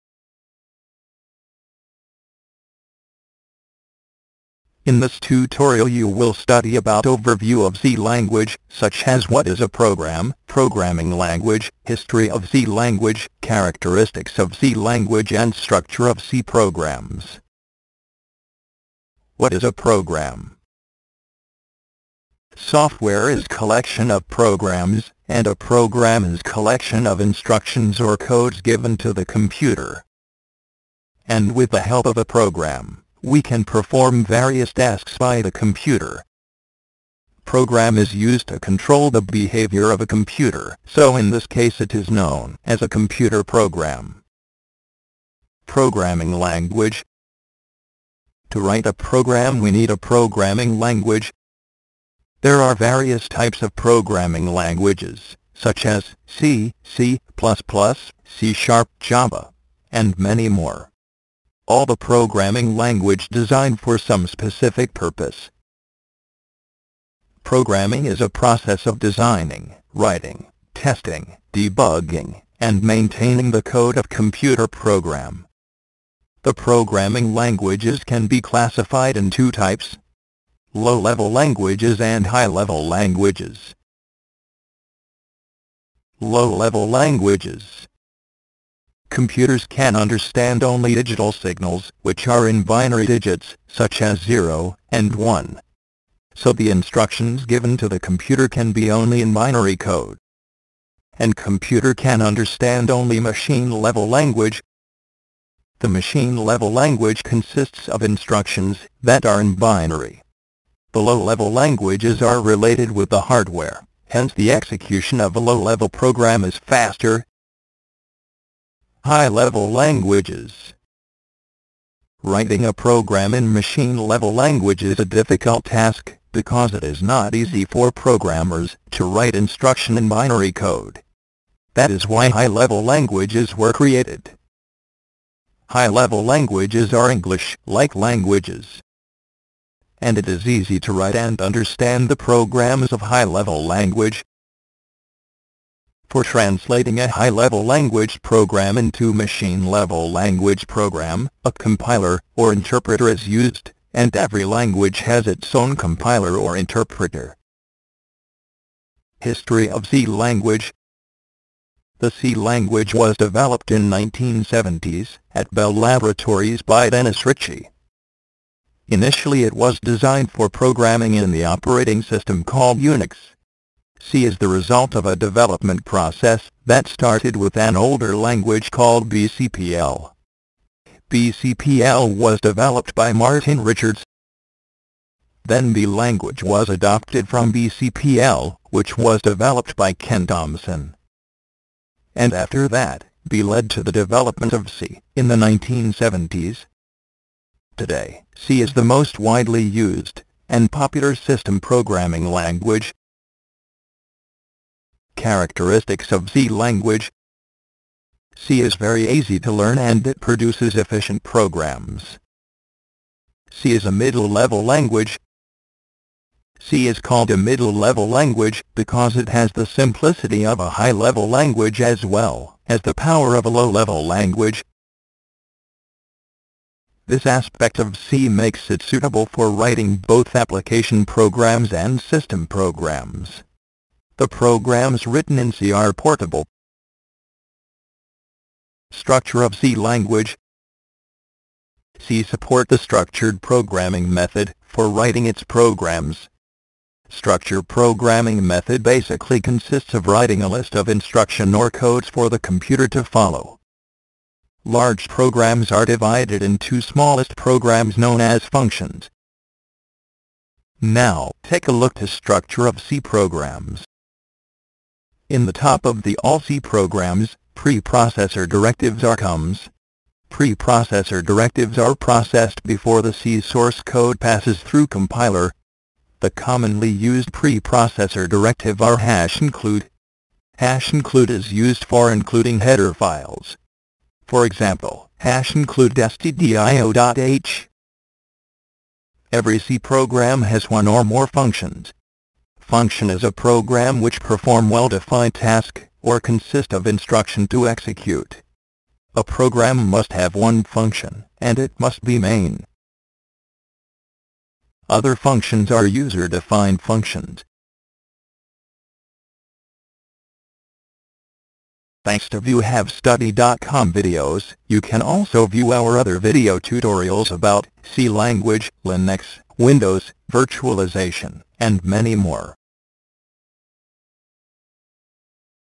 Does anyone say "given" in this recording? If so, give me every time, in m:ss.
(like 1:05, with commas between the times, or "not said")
0:28, 1:37.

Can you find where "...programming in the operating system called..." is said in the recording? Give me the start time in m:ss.
2:50.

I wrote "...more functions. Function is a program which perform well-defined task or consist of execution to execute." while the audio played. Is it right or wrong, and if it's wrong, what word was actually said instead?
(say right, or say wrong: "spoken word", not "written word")
wrong: "instruction", not "execution".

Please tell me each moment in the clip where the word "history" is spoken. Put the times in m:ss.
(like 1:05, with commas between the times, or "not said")
0:11, 2:39.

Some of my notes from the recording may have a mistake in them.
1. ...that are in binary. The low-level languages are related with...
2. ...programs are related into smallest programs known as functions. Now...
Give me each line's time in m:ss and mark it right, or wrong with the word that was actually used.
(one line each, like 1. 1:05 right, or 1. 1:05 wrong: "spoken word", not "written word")
1. 1:49 right
2. 4:15 wrong: "divided", not "related".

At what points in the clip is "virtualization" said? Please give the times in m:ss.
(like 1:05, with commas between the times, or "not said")
5:20.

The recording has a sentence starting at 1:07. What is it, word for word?
Programming is a process of designing, writing, testing, debugging, and maintaining the code of computer program.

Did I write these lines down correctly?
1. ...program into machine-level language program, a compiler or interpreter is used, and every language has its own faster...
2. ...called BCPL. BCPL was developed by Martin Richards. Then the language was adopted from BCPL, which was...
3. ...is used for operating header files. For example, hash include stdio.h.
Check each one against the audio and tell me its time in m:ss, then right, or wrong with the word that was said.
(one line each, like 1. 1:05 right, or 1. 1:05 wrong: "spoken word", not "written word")
1. 2:28 wrong: "compiler", not "faster"
2. 2:58 right
3. 4:41 wrong: "including", not "operating".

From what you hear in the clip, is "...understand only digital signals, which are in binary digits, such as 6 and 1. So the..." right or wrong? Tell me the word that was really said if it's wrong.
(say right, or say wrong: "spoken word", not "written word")
wrong: "0", not "6".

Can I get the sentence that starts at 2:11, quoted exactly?
That is why high-level languages were created.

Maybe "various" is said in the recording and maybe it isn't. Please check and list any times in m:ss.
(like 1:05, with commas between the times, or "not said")
0:34, 0:52.